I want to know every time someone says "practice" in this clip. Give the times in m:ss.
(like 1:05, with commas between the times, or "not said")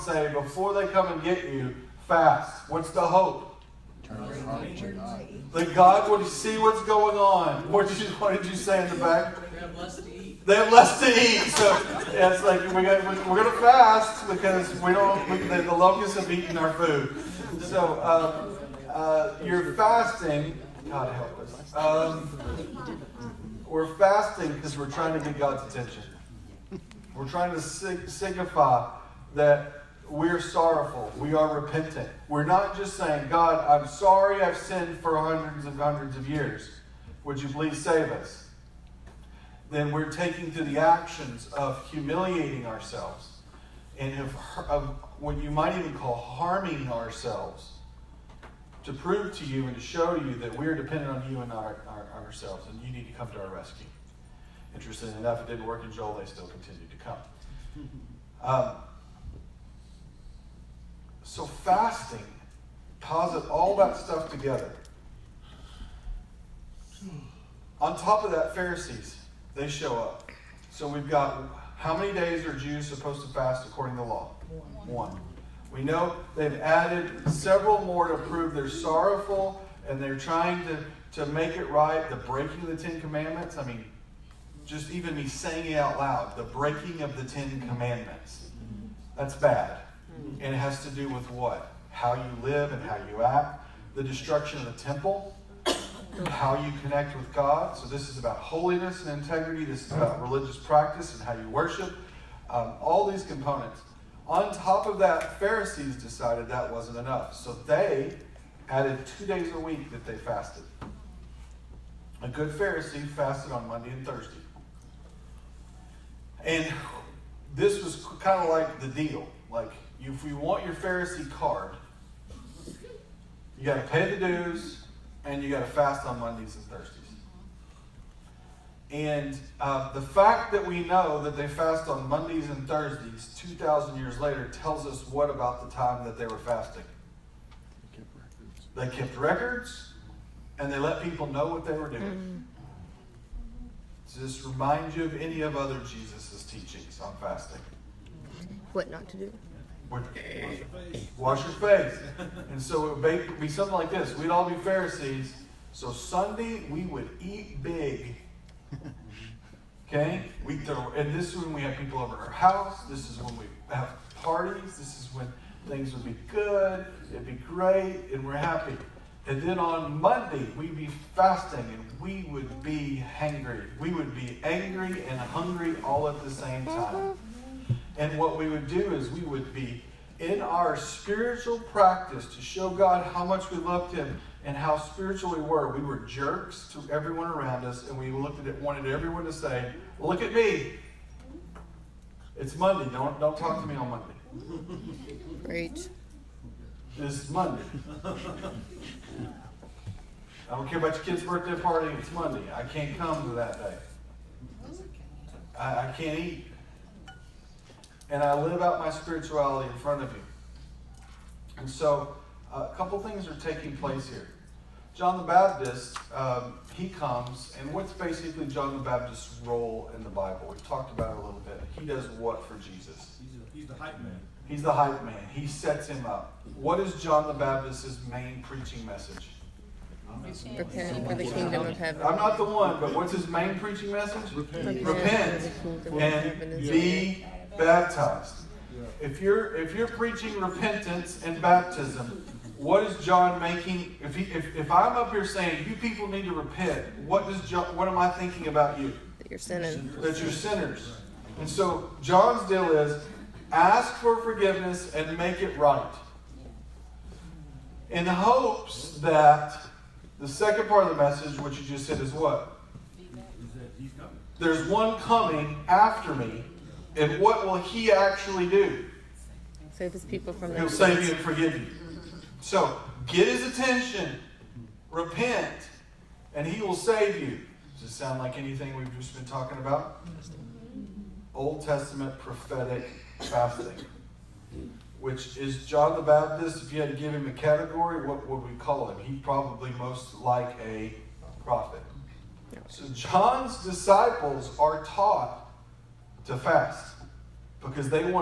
1:40, 3:01.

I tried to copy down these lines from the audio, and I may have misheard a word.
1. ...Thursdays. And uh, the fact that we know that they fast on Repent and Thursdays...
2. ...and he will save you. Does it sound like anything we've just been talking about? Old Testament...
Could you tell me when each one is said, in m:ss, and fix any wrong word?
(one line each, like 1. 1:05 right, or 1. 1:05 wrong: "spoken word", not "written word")
1. 2:06 wrong: "Mondays", not "Repent"
2. 4:36 right.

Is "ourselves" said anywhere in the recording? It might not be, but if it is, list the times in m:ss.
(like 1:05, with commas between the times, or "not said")
0:42, 0:46, 0:52.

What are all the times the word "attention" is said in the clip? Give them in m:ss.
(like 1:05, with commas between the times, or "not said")
0:25, 4:33.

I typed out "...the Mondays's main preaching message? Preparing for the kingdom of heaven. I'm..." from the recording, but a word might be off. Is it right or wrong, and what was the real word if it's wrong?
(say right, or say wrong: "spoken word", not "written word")
wrong: "Baptist", not "Mondays".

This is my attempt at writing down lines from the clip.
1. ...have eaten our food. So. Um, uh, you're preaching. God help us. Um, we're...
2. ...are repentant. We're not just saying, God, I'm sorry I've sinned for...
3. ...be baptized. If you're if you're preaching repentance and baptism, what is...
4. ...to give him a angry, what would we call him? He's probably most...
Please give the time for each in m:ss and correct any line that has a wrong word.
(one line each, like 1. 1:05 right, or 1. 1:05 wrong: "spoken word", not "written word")
1. 0:16 wrong: "fasting", not "preaching"
2. 0:31 right
3. 3:56 right
4. 4:46 wrong: "category", not "angry".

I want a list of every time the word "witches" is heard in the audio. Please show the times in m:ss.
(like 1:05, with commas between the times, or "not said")
not said.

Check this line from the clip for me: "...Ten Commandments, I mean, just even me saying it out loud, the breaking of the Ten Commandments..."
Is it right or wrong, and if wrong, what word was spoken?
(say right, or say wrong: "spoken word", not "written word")
right.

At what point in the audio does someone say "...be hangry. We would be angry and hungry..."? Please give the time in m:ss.
2:52.